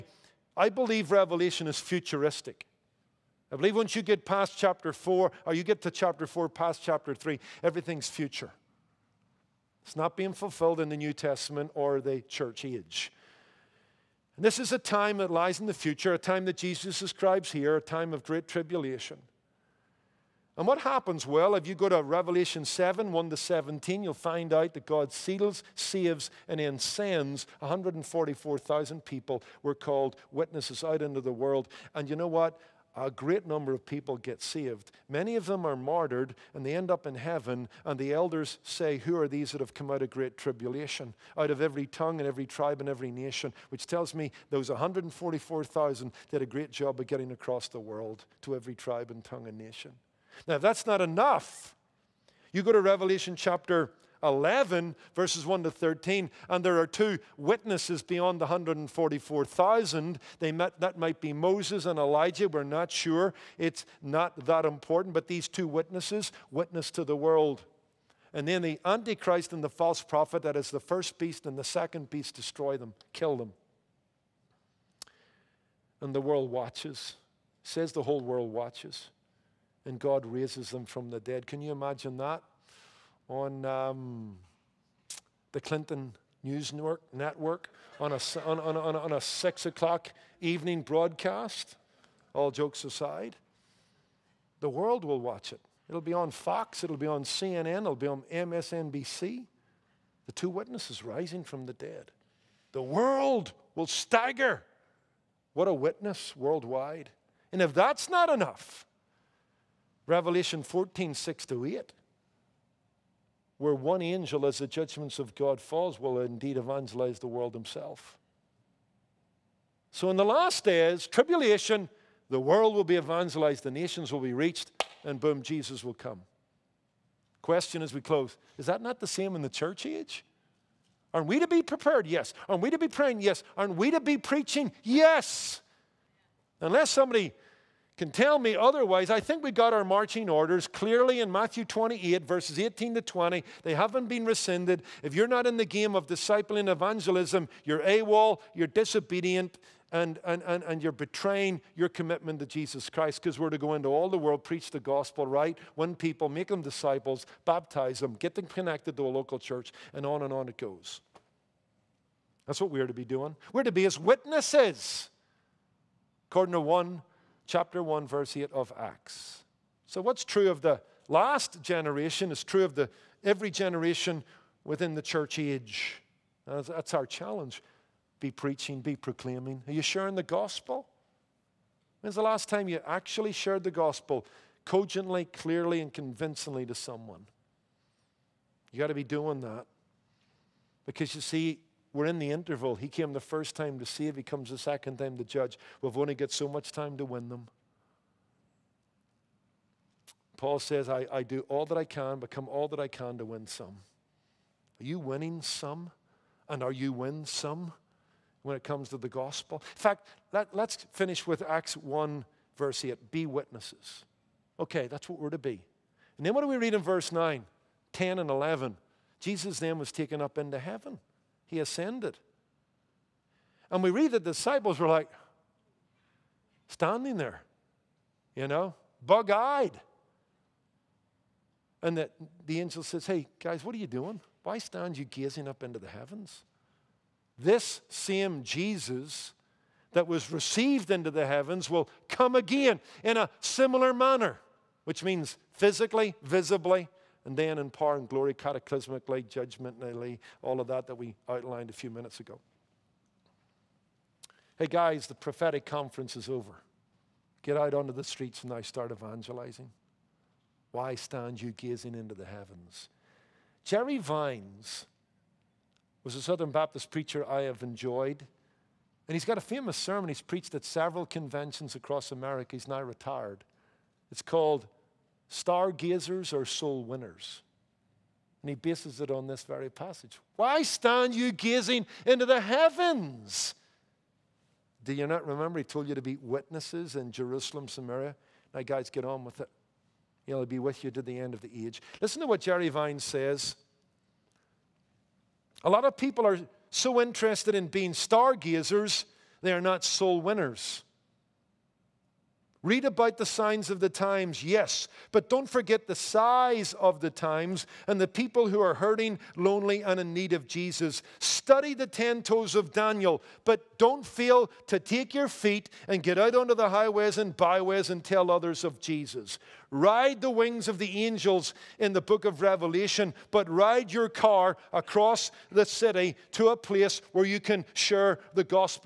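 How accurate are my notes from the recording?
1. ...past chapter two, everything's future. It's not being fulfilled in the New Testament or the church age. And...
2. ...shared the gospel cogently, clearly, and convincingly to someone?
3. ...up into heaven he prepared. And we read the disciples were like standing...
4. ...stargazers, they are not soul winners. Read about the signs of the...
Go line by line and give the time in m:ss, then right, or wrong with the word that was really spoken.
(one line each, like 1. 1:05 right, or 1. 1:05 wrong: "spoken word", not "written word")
1. 0:06 wrong: "three", not "two"
2. 3:03 right
3. 3:40 wrong: "ascended", not "prepared"
4. 4:57 right.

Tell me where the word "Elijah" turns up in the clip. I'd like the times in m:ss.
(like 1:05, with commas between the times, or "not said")
1:01.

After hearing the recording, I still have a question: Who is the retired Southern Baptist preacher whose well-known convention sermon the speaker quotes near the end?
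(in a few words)
Jerry Vines.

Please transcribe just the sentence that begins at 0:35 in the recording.
Many of them are martyred and they end up in heaven.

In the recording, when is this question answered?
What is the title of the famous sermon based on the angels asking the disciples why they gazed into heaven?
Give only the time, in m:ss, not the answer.
4:35.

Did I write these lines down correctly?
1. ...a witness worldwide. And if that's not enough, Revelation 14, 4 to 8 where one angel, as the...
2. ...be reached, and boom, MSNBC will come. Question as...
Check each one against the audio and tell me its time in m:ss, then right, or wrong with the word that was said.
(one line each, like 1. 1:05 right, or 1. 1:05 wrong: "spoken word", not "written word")
1. 1:45 wrong: "6", not "4"
2. 2:04 wrong: "Jesus", not "MSNBC".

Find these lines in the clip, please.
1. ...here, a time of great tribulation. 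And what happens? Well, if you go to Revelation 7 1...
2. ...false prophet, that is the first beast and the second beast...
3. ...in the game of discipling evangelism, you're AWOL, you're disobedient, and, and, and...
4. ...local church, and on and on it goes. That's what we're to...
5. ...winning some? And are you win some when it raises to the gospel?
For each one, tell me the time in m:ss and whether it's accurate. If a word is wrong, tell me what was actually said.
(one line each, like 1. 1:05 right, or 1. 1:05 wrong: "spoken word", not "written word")
1. 0:17 right
2. 1:09 right
3. 2:25 right
4. 2:39 right
5. 3:24 wrong: "comes", not "raises".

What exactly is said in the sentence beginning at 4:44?
Do you not remember he told you to be witnesses in Jerusalem, Samaria?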